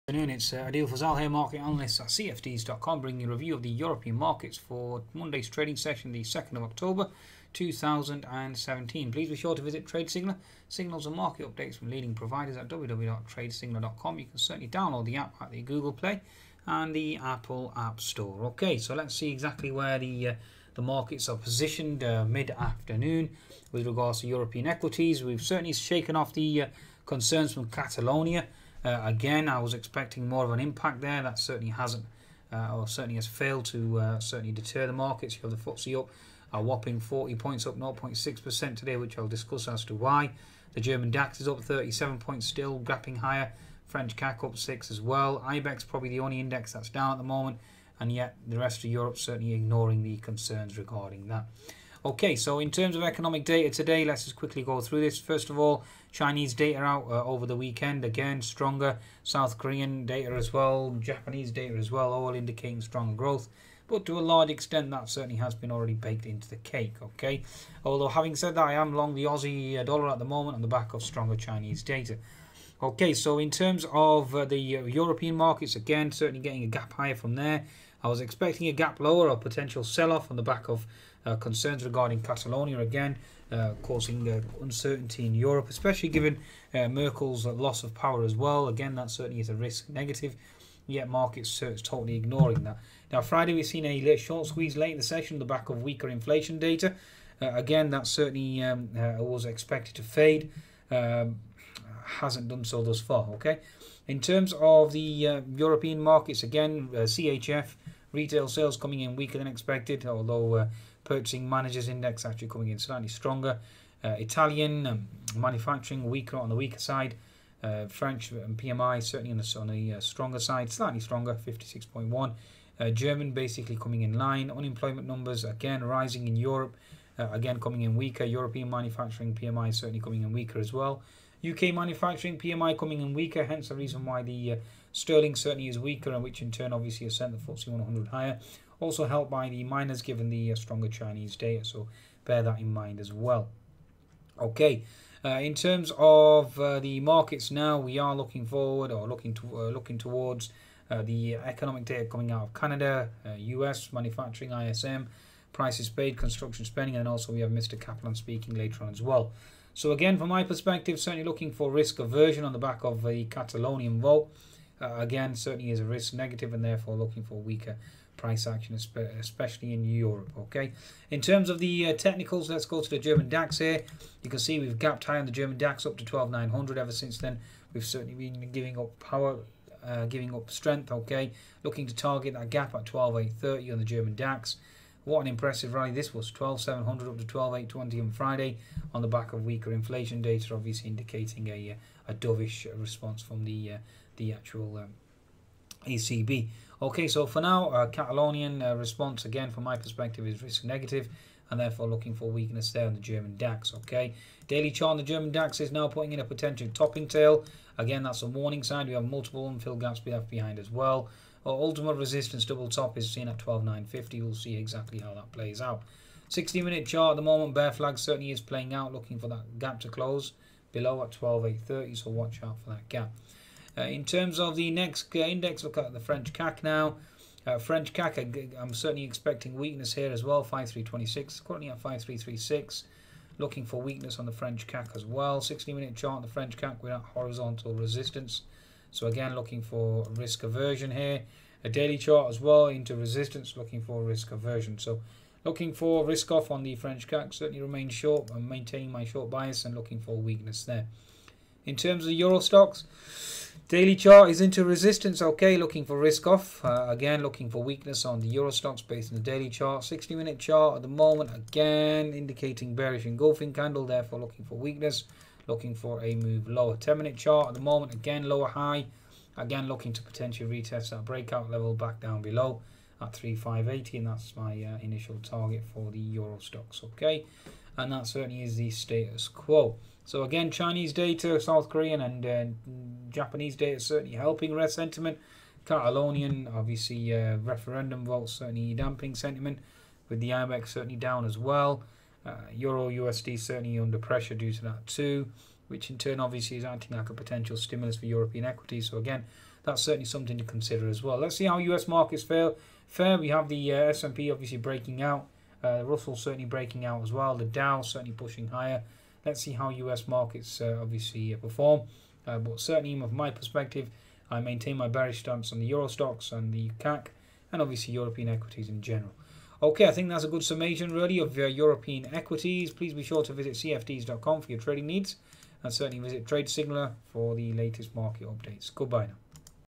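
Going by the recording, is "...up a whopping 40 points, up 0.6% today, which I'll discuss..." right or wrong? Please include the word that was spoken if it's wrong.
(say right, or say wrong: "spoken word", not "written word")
right.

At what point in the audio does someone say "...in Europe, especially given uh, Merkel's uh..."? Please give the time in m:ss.
1:25.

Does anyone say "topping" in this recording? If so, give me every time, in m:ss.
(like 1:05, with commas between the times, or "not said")
3:26.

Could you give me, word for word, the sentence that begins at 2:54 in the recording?
You can see we've gapped high on the German DAX up to 12,900.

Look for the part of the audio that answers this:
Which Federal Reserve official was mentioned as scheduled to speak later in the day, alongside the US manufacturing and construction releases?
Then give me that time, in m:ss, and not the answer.
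2:37.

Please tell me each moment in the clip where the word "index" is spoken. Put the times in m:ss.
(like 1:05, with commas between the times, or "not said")
0:46, 1:51, 3:45.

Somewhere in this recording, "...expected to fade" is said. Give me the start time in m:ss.
1:39.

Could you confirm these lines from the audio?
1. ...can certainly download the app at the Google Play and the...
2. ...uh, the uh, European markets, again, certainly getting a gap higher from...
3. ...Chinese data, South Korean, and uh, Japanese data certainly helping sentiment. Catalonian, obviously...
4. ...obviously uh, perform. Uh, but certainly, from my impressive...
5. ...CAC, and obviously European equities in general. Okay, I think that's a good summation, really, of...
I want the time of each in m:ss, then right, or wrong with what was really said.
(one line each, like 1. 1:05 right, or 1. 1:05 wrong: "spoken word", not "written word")
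1. 0:14 right
2. 1:14 right
3. 4:40 right
4. 5:10 wrong: "perspective", not "impressive"
5. 5:16 right.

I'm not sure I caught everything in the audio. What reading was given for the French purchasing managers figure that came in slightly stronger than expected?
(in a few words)
56.1.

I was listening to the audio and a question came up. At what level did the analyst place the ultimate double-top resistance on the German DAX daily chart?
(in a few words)
12,950.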